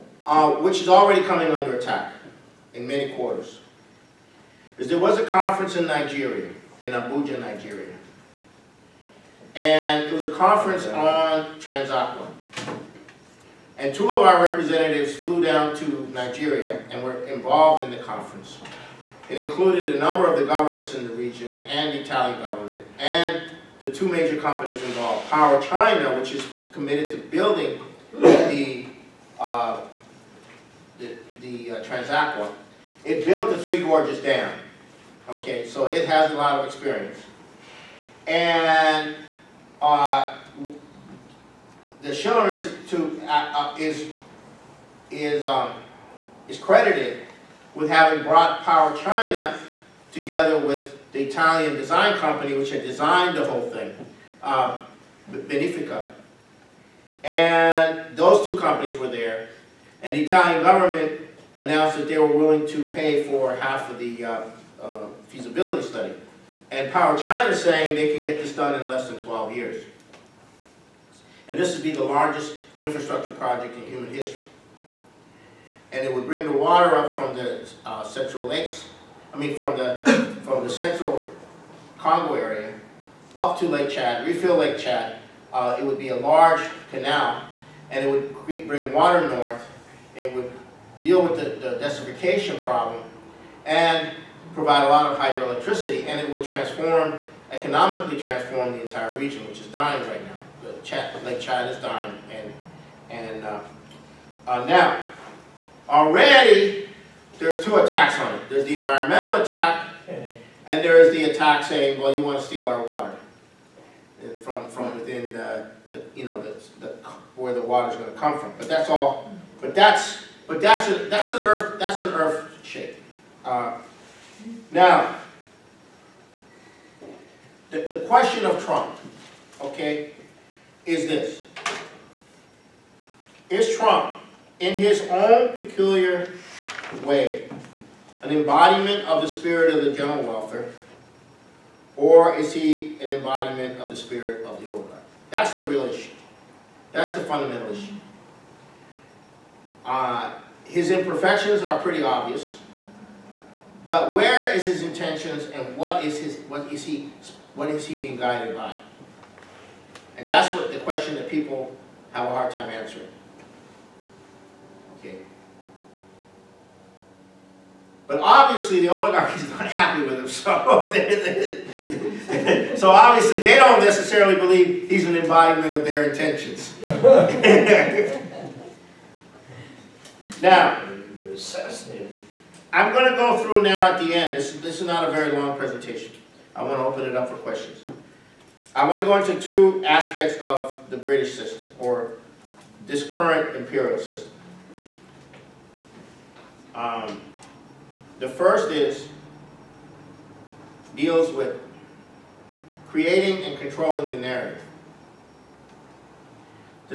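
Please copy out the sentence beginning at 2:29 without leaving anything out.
Uh, his imperfections are pretty obvious.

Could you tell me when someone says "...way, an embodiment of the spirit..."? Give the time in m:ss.
2:17.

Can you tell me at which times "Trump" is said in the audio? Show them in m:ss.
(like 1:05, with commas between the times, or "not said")
2:08, 2:13.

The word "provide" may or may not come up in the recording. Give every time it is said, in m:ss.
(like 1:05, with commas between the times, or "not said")
1:34.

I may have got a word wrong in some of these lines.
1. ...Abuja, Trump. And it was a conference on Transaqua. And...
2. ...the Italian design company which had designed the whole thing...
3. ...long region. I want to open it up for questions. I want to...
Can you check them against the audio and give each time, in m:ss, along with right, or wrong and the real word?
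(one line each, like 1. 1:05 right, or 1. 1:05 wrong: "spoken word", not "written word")
1. 0:06 wrong: "Nigeria", not "Trump"
2. 0:51 right
3. 3:05 wrong: "presentation", not "region".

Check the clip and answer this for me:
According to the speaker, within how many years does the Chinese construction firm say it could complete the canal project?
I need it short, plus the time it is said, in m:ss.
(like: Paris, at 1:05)
12 years, at 1:09.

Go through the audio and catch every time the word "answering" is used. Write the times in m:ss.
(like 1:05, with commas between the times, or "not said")
2:42.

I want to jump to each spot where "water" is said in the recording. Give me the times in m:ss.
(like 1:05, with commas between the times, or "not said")
1:16, 1:28, 1:52.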